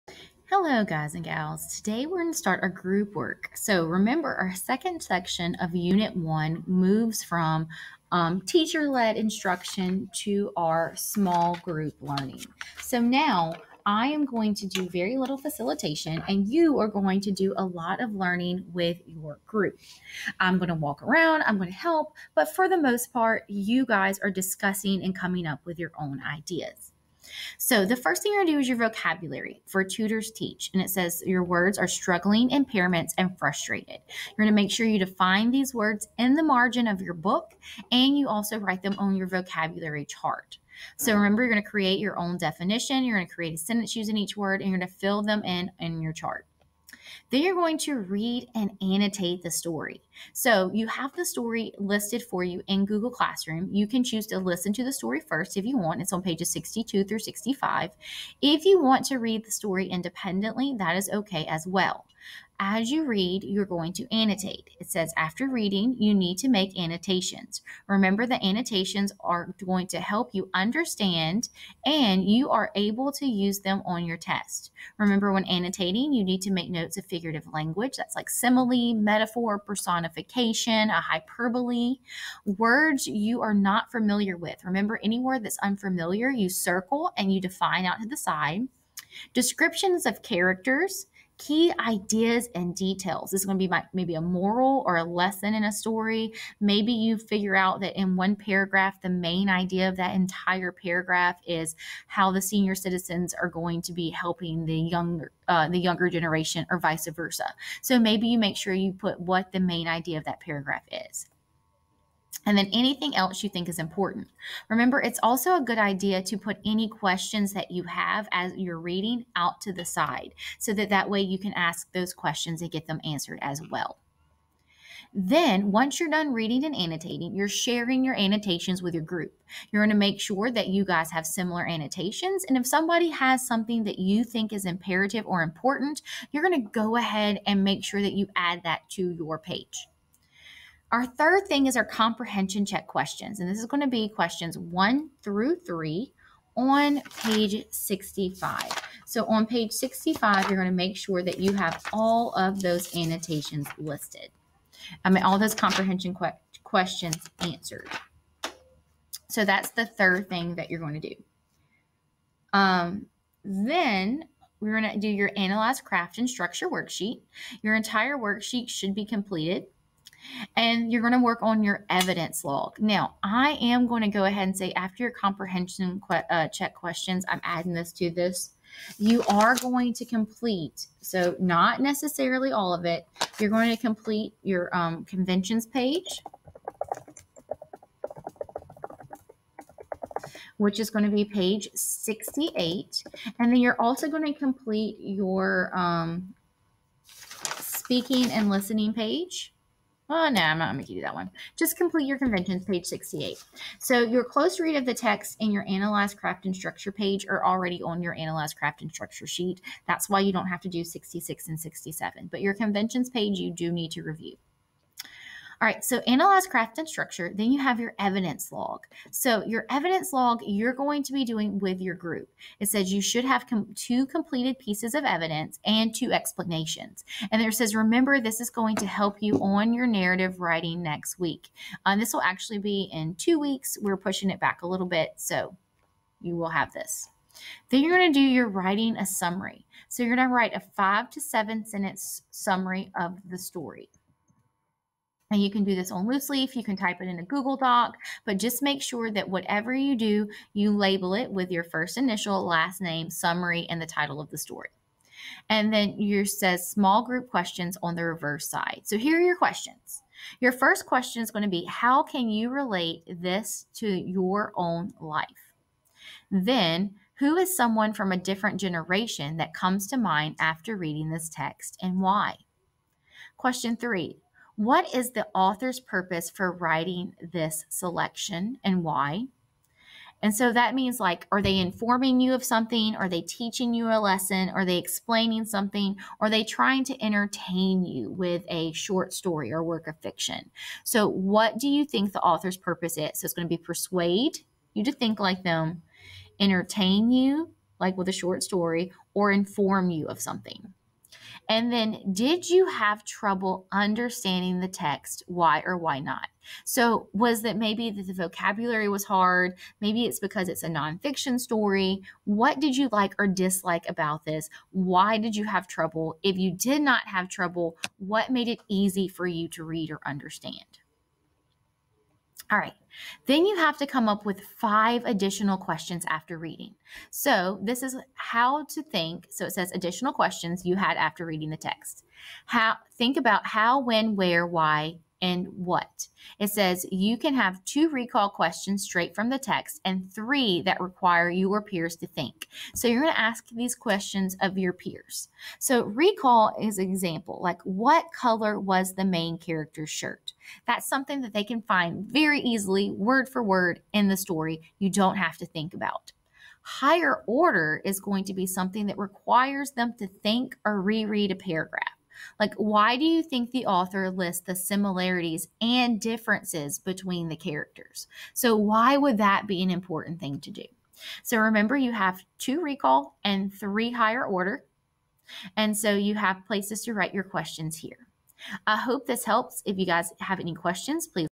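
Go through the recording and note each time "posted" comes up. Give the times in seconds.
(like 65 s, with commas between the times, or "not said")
not said.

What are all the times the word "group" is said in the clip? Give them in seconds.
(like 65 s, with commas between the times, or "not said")
2 s, 11 s, 19 s, 129 s, 221 s, 257 s.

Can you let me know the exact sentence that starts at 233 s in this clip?
We're pushing it back a little bit, so you will have this.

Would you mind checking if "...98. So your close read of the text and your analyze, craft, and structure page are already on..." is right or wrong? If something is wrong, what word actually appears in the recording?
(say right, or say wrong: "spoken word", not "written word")
wrong: "68", not "98".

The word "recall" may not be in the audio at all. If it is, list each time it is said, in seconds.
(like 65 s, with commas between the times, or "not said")
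337 s, 345 s, 372 s.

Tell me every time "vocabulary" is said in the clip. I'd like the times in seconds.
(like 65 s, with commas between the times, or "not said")
28 s, 39 s, 308 s.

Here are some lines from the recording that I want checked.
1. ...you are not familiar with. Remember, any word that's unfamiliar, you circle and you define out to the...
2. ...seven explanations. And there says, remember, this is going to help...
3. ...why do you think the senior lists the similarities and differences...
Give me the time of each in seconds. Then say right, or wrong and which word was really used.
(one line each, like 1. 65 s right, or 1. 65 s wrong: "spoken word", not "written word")
1. 83 s right
2. 225 s wrong: "two", not "seven"
3. 362 s wrong: "author", not "senior".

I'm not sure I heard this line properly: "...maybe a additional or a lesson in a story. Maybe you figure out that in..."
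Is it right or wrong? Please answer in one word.
wrong.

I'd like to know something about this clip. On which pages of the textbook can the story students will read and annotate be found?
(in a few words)
62 through 65.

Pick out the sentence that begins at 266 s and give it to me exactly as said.
Then, who is someone from a different generation that comes to mind after reading this text and why?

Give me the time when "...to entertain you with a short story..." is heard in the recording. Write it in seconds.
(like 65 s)
286 s.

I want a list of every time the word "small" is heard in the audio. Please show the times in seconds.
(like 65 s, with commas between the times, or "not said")
10 s, 256 s.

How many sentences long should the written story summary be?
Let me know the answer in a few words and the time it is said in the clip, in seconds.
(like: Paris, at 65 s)
5 to 7, at 240 s.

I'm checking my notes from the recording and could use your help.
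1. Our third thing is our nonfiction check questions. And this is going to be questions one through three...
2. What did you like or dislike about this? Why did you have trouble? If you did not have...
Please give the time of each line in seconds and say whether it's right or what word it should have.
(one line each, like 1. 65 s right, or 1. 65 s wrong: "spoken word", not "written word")
1. 140 s wrong: "comprehension", not "nonfiction"
2. 312 s right.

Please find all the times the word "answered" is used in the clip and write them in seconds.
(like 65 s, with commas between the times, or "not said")
123 s, 157 s.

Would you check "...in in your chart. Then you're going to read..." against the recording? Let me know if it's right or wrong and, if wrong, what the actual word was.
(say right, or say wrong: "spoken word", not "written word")
right.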